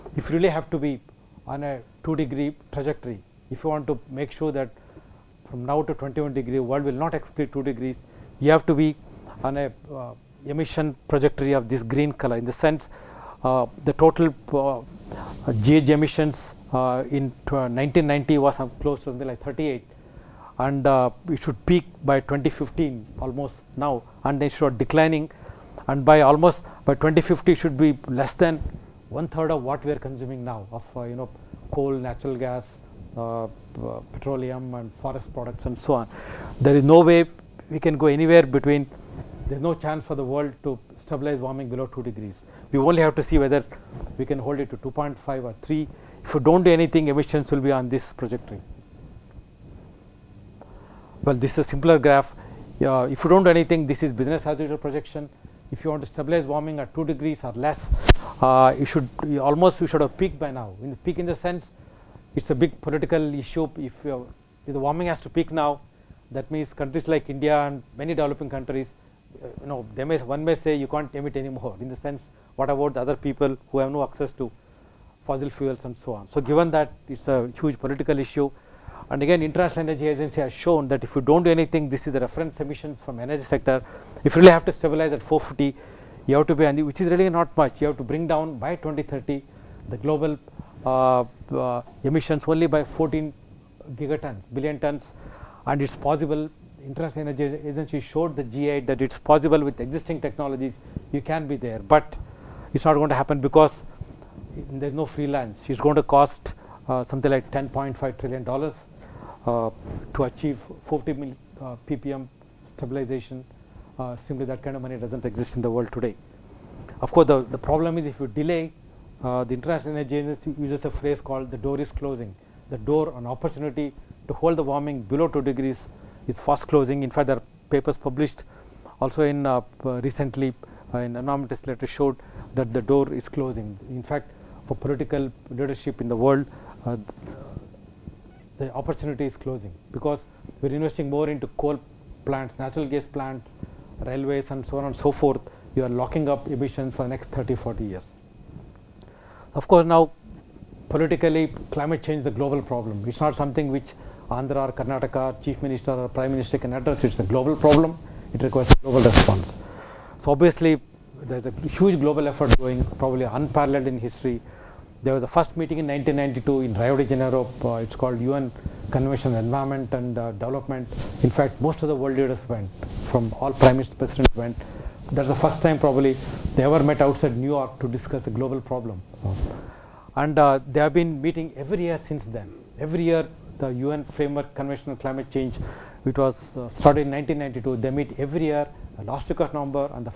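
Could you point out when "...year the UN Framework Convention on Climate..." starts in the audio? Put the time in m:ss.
3:03.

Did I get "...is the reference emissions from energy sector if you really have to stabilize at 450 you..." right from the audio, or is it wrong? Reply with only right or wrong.
right.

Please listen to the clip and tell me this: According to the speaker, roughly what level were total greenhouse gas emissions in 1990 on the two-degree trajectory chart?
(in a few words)
38.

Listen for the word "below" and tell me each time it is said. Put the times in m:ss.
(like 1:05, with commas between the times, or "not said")
0:41, 2:05.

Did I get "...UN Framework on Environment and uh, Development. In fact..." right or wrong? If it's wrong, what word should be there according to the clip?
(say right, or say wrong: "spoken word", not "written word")
wrong: "Convention", not "Framework".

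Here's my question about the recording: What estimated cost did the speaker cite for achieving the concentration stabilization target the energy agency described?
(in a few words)
$10.5 trillion.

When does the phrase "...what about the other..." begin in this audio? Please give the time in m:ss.
1:12.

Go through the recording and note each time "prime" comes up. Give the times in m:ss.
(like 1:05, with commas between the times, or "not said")
2:36, 2:53.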